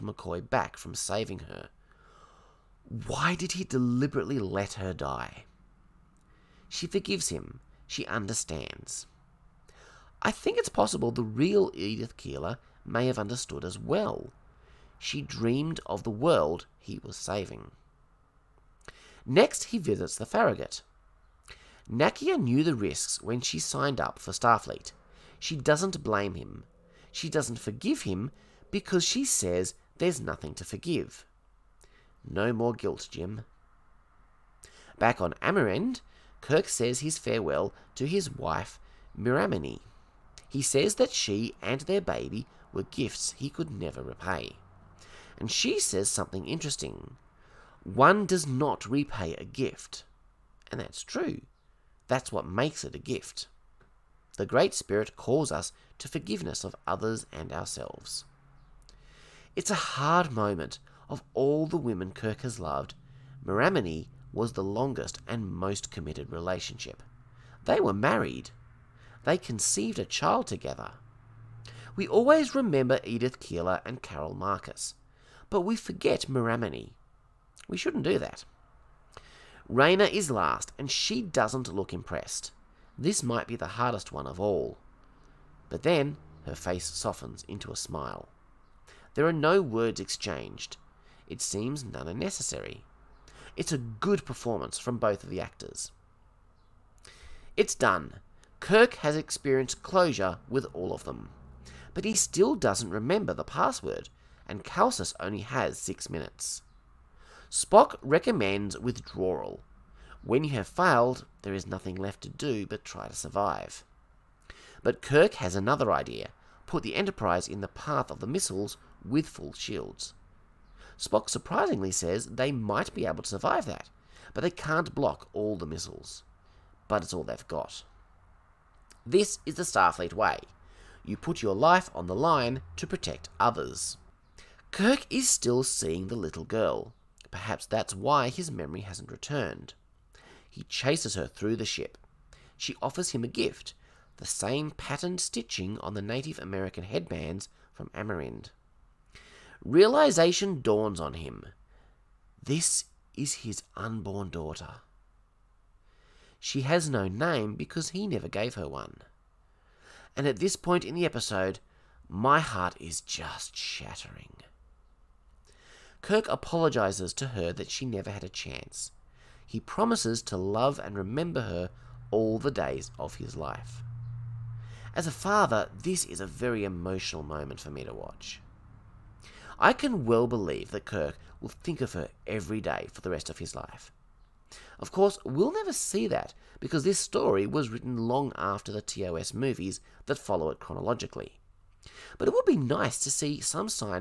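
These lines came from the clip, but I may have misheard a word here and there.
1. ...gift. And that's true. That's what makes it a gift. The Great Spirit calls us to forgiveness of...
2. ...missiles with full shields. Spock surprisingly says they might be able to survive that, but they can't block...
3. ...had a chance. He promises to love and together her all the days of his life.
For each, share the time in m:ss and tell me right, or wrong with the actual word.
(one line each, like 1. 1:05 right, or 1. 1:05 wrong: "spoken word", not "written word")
1. 0:49 right
2. 1:58 right
3. 2:48 wrong: "remember", not "together".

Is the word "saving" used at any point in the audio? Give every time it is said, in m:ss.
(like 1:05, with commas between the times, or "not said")
0:00, 0:17.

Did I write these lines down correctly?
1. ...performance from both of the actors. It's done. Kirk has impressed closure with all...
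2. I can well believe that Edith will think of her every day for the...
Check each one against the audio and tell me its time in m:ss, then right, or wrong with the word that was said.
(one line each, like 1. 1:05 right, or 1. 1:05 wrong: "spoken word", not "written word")
1. 1:34 wrong: "experienced", not "impressed"
2. 2:59 wrong: "Kirk", not "Edith".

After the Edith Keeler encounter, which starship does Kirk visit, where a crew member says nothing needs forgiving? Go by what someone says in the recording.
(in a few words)
Farragut.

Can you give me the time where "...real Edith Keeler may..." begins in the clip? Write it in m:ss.
0:11.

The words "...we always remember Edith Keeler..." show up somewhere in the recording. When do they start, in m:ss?
1:11.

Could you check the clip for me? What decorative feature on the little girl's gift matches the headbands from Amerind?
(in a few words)
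patterned stitching.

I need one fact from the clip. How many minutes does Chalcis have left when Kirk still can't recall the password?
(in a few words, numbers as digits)
6.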